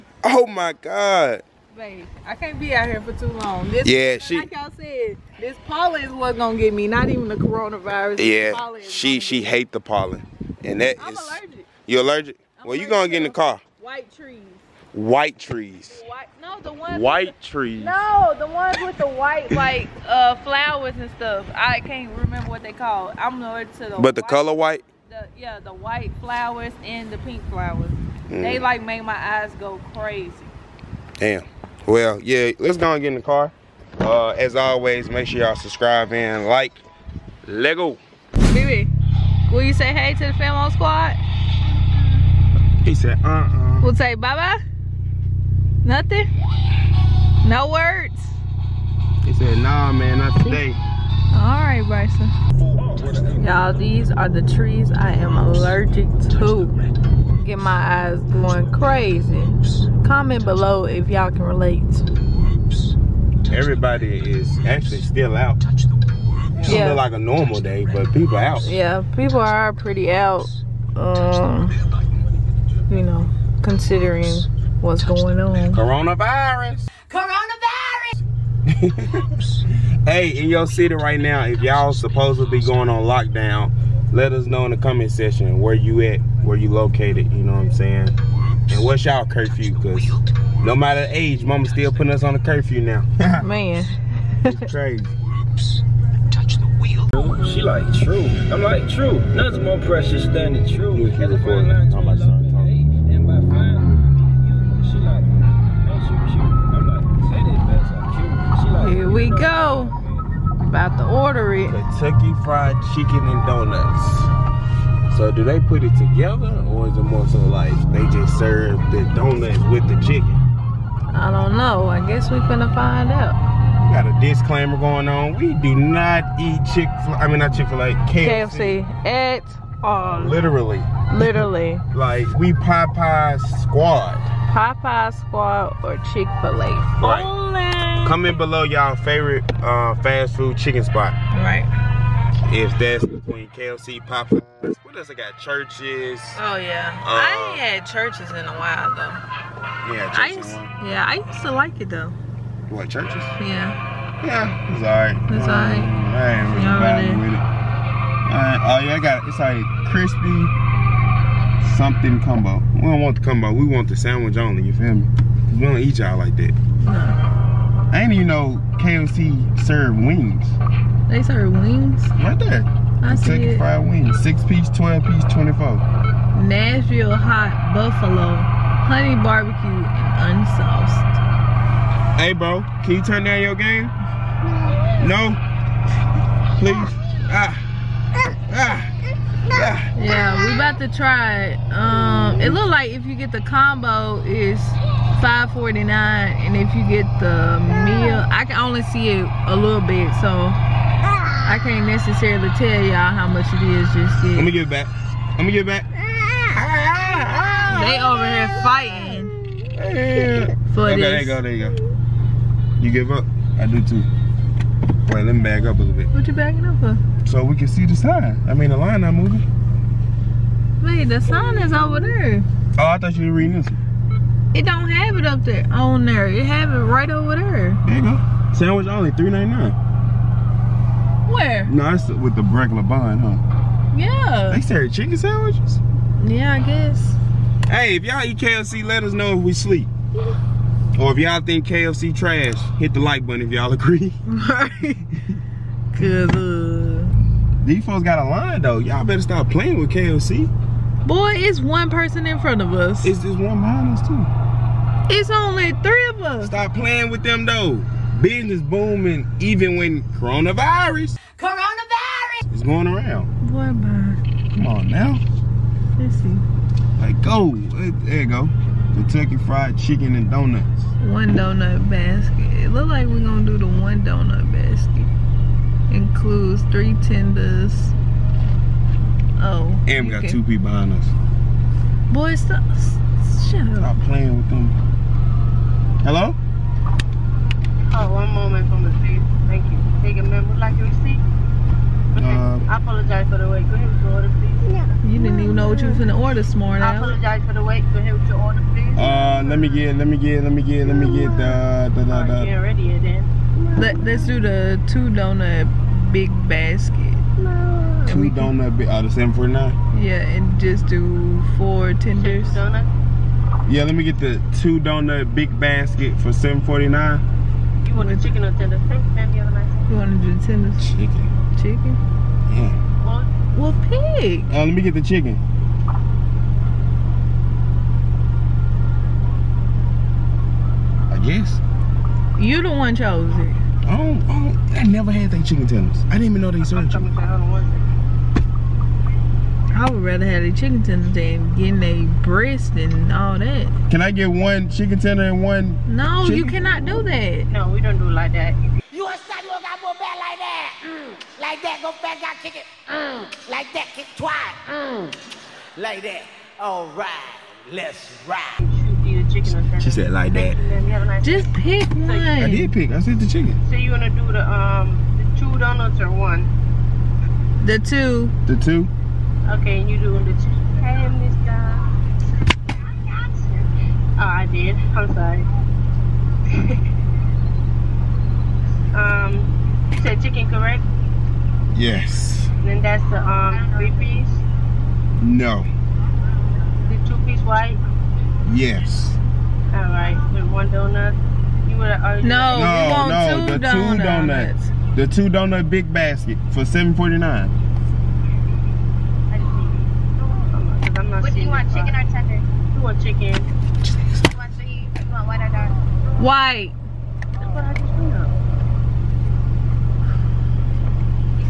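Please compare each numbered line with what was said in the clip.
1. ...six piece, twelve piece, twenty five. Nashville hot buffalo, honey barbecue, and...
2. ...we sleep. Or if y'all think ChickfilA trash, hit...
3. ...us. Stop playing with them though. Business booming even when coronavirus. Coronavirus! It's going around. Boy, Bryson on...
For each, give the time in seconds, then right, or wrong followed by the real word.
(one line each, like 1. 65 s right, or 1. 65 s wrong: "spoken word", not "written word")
1. 174 s wrong: "four", not "five"
2. 239 s wrong: "KFC", not "ChickfilA"
3. 256 s wrong: "Come", not "Bryson".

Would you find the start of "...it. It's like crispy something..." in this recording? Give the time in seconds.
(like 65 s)
159 s.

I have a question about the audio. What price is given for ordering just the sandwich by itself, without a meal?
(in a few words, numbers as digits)
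$3.99.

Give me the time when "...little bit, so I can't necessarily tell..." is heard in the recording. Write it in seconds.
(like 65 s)
199 s.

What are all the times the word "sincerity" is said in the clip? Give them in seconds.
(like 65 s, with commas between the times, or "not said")
not said.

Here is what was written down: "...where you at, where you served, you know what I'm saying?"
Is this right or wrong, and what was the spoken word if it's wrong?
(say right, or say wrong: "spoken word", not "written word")
wrong: "located", not "served".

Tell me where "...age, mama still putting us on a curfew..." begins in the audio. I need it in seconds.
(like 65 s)
91 s.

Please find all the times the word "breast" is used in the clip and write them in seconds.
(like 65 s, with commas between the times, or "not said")
342 s.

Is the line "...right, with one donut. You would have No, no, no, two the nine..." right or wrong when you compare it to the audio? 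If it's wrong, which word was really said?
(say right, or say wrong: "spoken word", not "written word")
wrong: "two", not "nine".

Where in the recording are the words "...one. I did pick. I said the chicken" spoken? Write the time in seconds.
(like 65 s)
361 s.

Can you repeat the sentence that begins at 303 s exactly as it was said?
Let Let's do the two donut big basket.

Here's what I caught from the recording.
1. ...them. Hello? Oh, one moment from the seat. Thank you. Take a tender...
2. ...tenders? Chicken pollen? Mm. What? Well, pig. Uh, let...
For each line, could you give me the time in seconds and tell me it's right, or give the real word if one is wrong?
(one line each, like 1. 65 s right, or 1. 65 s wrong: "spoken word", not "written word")
1. 284 s wrong: "member", not "tender"
2. 320 s wrong: "chicken", not "pollen".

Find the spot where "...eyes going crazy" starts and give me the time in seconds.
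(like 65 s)
57 s.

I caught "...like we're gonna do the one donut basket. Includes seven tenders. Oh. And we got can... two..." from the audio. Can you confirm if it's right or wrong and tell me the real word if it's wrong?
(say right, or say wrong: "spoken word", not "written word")
wrong: "three", not "seven".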